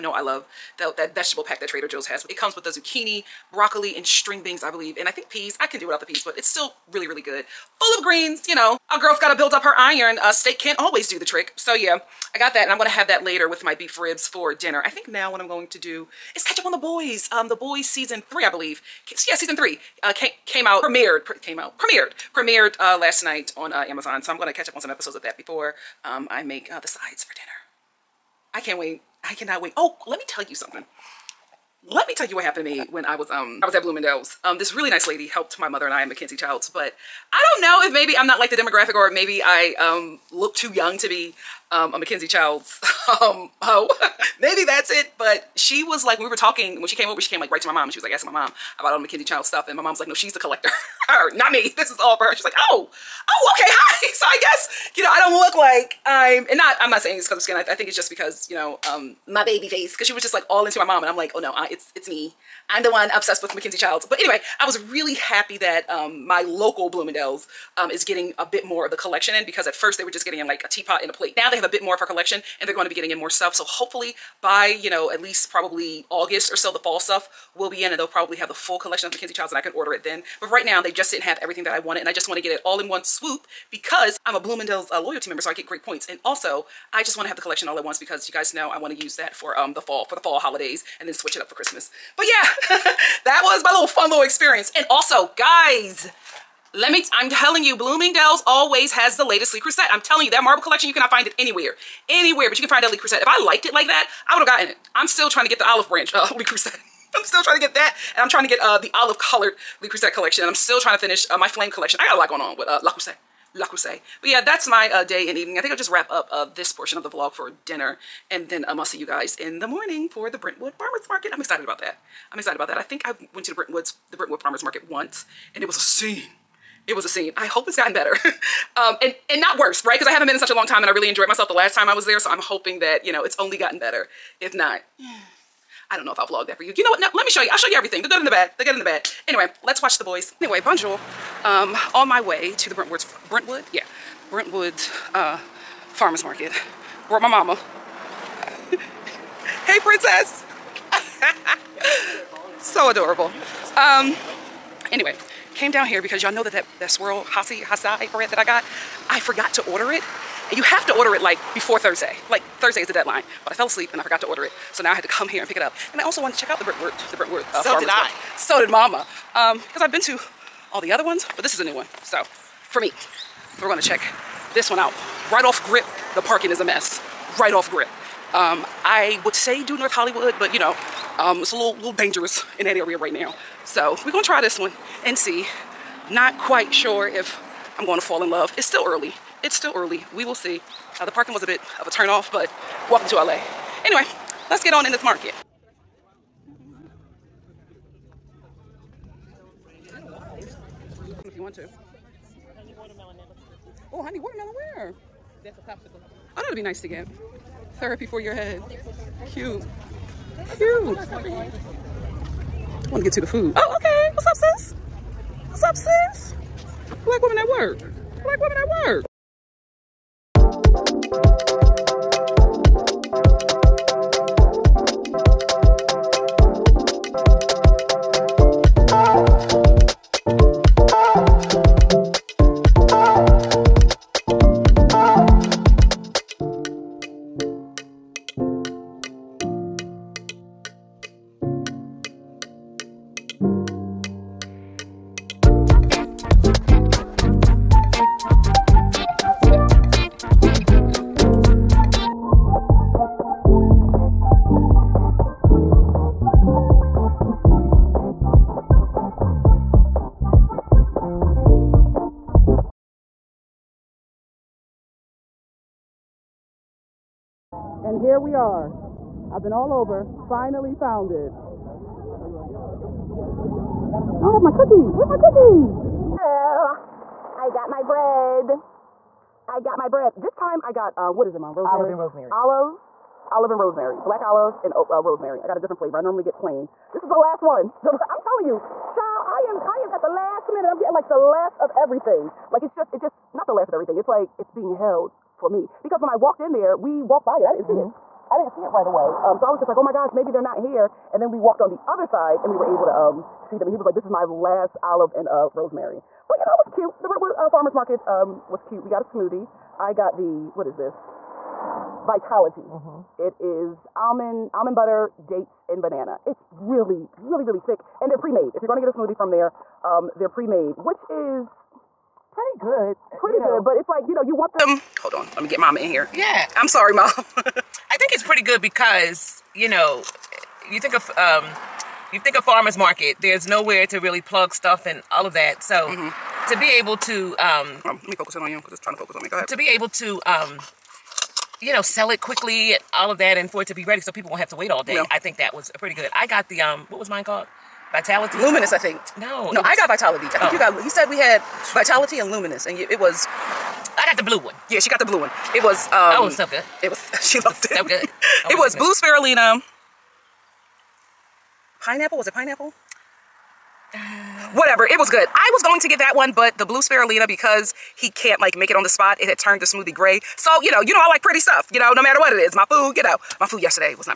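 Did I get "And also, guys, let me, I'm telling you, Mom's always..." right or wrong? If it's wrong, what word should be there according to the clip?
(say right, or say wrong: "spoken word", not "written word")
wrong: "Bloomingdale", not "Mom".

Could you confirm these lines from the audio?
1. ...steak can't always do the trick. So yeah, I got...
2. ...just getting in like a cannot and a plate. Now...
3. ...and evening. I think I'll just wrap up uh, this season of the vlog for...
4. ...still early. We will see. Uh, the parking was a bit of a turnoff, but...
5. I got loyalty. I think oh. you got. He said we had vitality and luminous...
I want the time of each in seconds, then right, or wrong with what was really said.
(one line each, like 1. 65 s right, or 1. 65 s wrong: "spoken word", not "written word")
1. 10 s right
2. 70 s wrong: "teapot", not "cannot"
3. 115 s wrong: "portion", not "season"
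4. 189 s right
5. 349 s wrong: "vitality", not "loyalty".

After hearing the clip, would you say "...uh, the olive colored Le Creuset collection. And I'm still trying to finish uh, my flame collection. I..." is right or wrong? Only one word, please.
right.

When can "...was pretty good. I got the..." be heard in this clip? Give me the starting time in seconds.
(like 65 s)
345 s.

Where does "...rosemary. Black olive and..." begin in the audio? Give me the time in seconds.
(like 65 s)
283 s.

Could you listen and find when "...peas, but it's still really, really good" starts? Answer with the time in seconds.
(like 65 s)
6 s.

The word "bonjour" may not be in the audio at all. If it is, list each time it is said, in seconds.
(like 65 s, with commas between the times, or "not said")
140 s.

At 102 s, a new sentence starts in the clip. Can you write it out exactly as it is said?
Anywhere, but you can find that Le Creuset.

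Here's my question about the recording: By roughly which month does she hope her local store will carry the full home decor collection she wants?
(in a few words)
August.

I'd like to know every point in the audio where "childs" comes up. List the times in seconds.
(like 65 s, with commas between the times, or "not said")
36 s, 42 s, 49 s, 63 s, 79 s, 288 s.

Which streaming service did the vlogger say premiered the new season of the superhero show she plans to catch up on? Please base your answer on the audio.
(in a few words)
Amazon.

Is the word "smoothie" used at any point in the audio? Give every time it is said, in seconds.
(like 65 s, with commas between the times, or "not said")
309 s, 318 s, 369 s.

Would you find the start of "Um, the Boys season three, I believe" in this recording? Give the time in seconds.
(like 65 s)
17 s.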